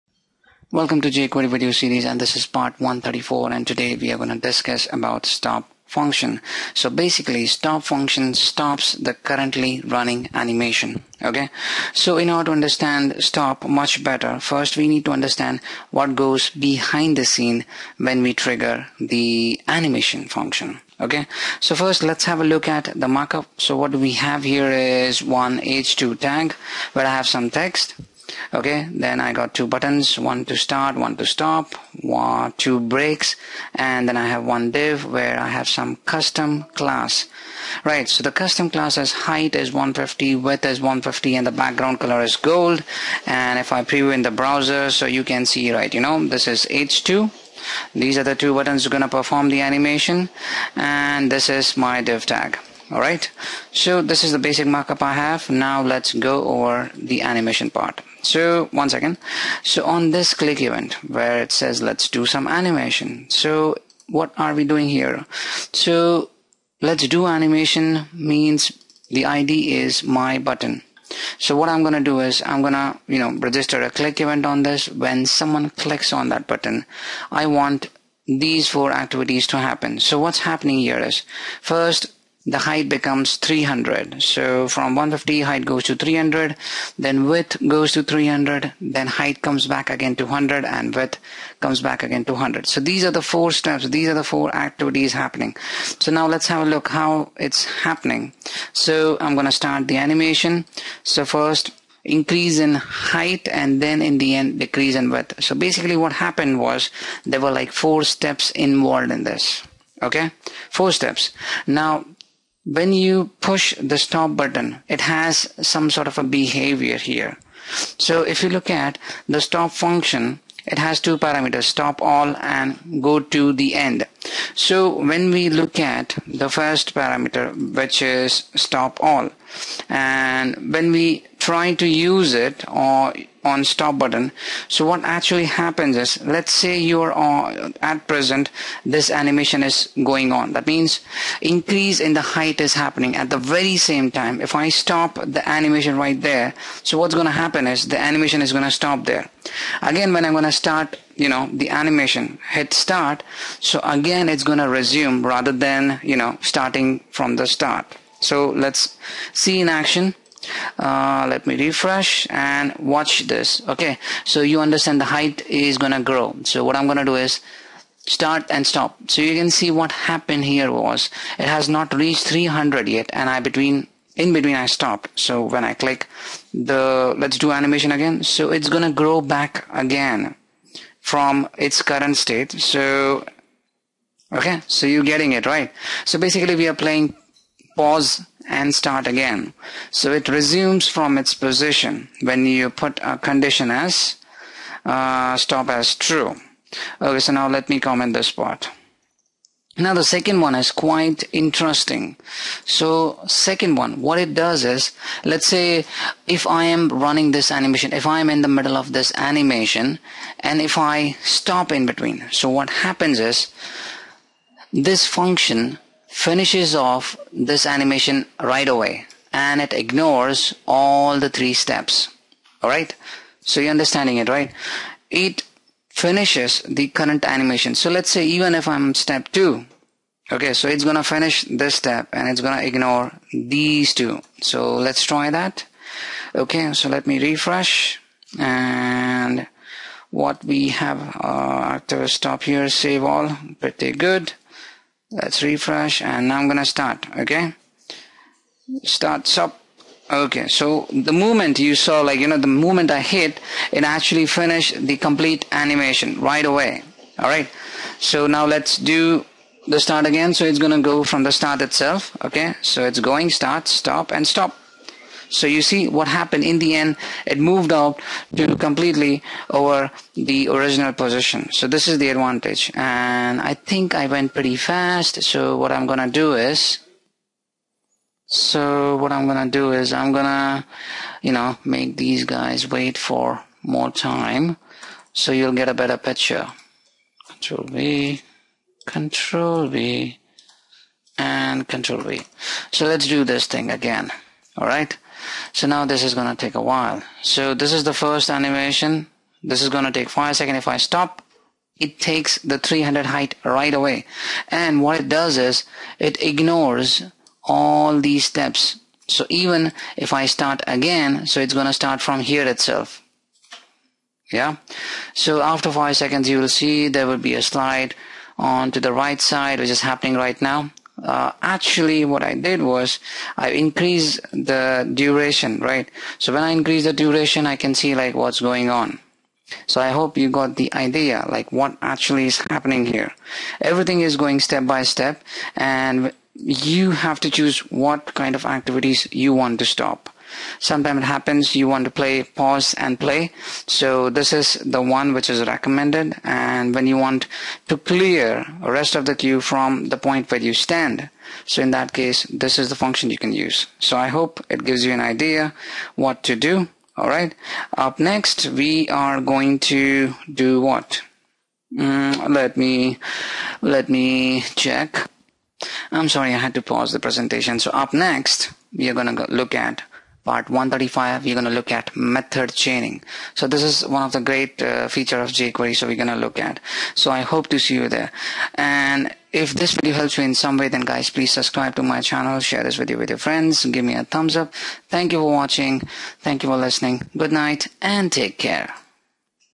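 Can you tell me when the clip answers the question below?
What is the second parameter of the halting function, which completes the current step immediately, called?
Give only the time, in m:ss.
2:03.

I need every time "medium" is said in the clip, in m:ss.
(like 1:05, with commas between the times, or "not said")
not said.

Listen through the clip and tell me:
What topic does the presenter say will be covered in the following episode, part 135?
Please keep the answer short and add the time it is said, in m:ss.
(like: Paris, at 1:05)
method chaining, at 6:11.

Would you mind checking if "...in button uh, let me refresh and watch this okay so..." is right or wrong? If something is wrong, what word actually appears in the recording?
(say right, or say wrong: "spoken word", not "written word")
wrong: "action", not "button".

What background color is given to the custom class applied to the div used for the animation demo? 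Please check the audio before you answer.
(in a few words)
gold.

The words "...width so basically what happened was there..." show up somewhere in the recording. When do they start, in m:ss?
1:45.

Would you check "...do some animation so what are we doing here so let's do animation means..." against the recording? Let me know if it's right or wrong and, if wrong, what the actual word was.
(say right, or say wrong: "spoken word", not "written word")
right.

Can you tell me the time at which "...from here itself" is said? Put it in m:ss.
5:12.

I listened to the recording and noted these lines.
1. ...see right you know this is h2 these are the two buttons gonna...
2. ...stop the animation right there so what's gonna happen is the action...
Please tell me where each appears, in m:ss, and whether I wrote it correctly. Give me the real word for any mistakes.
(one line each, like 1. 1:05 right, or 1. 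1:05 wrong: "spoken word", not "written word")
1. 0:45 right
2. 2:24 wrong: "animation", not "action".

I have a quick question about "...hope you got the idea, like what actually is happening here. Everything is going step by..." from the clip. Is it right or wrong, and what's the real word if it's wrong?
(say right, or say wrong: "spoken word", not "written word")
right.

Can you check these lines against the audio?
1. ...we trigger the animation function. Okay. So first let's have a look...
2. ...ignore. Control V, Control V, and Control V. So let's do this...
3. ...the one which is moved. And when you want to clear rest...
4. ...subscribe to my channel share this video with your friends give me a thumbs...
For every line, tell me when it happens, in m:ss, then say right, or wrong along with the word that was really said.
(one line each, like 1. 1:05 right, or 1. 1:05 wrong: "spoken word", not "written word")
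1. 0:18 right
2. 4:45 wrong: "picture", not "ignore"
3. 5:44 wrong: "recommended", not "moved"
4. 6:21 right.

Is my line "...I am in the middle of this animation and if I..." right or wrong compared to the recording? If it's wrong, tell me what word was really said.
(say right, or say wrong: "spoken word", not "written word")
right.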